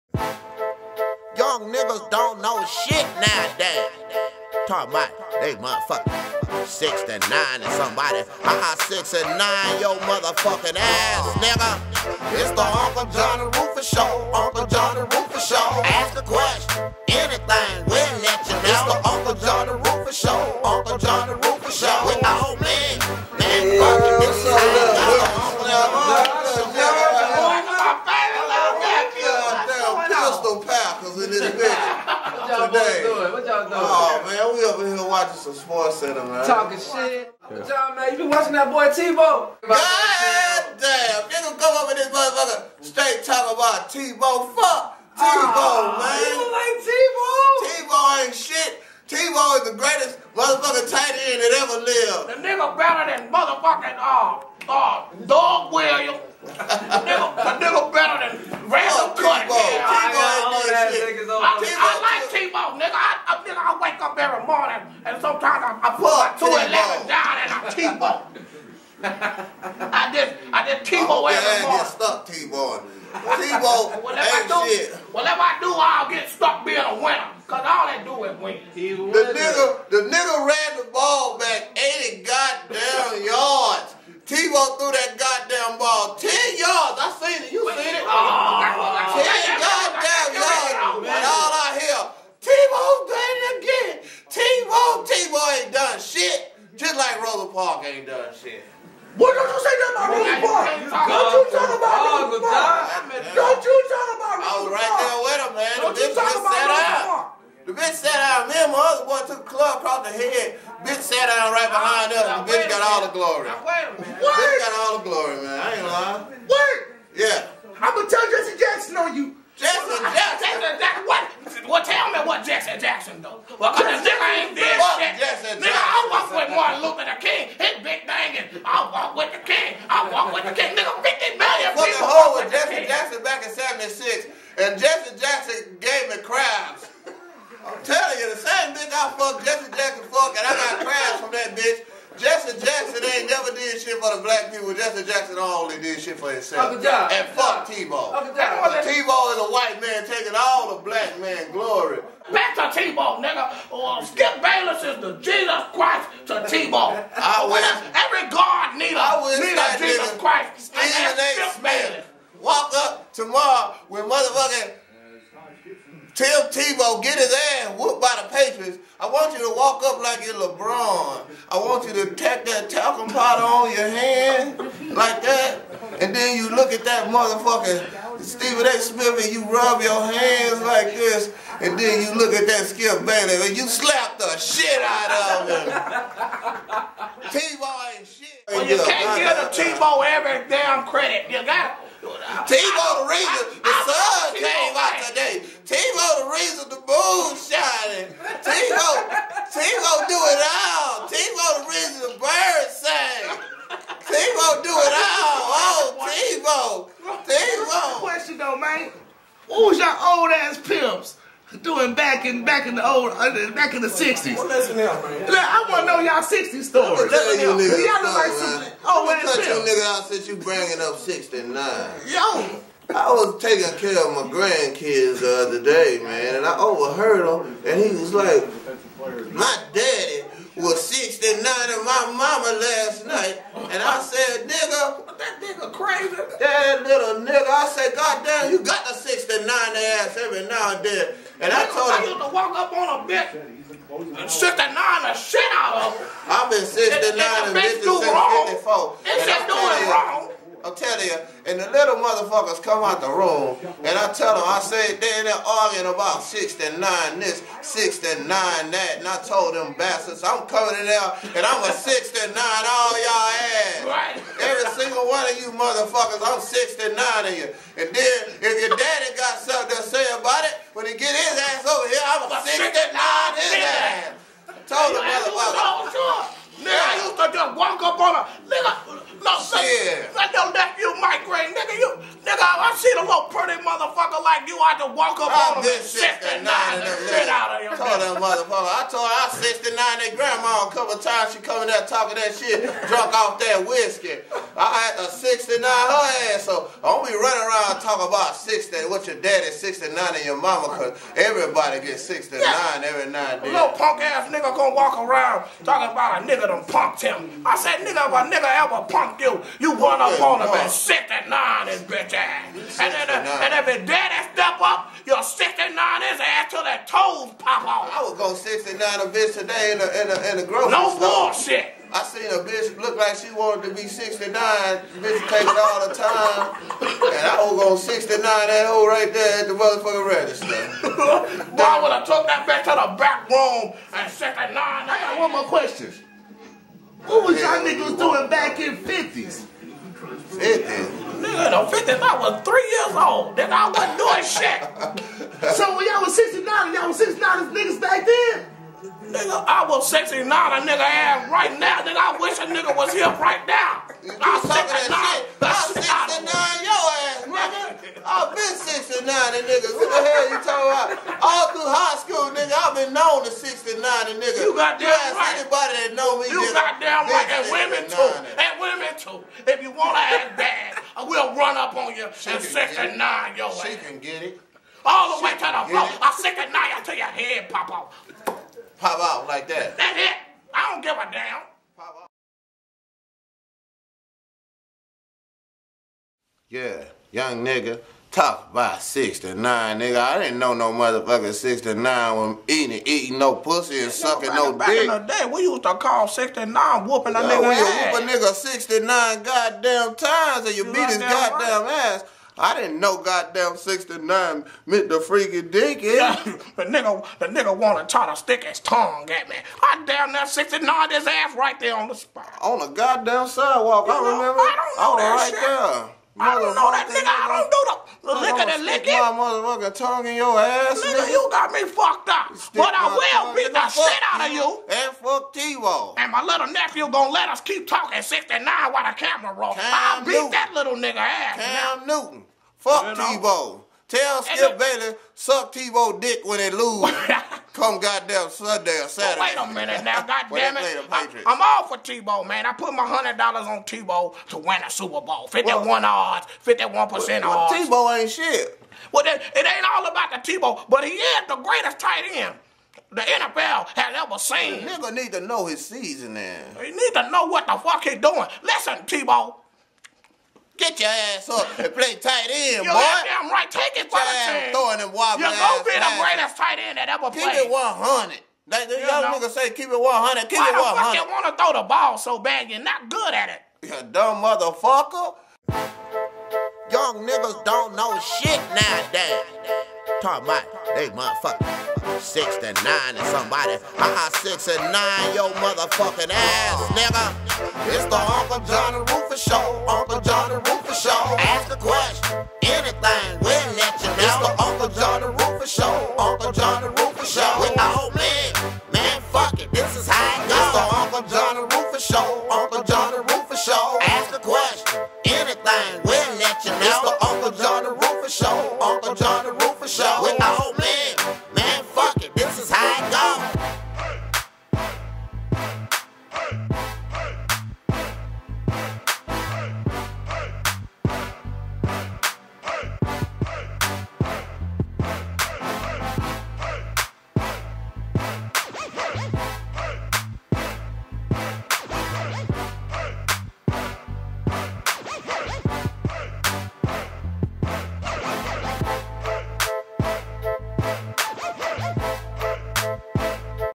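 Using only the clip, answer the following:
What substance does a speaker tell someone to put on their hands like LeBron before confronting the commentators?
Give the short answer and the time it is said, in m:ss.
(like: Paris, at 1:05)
talcum powder, at 2:52.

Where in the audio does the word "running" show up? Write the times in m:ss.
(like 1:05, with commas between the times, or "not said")
4:57.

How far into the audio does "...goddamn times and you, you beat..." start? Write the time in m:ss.
6:39.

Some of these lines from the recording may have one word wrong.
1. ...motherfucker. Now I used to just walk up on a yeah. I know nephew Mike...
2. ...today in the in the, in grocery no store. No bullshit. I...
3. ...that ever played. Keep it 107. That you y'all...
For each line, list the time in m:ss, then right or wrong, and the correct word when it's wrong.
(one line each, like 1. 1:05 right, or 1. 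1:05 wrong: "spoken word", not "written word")
1. 4:35 right
2. 5:19 right
3. 7:46 wrong: "100", not "107".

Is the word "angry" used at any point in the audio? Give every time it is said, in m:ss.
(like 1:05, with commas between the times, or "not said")
not said.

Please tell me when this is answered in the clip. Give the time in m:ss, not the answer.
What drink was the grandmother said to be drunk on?
4:53.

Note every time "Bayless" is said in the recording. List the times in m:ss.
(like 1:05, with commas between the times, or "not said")
2:34, 2:41.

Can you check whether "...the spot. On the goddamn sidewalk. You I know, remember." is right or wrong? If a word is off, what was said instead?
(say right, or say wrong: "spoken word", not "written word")
right.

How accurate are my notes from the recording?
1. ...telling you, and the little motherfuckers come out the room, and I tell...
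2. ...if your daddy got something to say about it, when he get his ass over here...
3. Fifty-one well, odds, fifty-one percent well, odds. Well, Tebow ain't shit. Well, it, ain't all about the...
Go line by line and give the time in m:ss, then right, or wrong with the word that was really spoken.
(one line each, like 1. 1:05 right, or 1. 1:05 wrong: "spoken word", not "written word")
1. 4:10 right
2. 4:28 right
3. 7:25 right.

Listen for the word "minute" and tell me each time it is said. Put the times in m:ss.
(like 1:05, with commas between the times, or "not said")
1:53, 7:19.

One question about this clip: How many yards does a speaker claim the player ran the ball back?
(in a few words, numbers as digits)
80.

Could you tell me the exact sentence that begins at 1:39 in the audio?
What don't you say that about Ruger Park?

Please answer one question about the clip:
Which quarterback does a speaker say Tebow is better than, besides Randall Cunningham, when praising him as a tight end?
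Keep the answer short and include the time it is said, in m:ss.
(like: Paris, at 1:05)
Doug Williams, at 0:55.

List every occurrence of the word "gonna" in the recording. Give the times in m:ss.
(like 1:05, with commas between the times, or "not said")
1:57, 5:04, 7:06.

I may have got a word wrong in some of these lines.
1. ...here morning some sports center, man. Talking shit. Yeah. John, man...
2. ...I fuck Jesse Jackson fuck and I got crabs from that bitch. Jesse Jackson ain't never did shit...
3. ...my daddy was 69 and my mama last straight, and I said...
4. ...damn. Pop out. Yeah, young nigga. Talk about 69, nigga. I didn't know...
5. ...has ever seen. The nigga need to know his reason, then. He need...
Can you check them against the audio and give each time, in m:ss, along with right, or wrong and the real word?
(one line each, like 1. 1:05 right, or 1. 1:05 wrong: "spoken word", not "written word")
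1. 0:34 wrong: "watching", not "morning"
2. 2:19 right
3. 3:49 wrong: "night", not "straight"
4. 6:21 right
5. 7:33 wrong: "season", not "reason".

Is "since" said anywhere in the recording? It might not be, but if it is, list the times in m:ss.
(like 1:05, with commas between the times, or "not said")
3:40, 5:41.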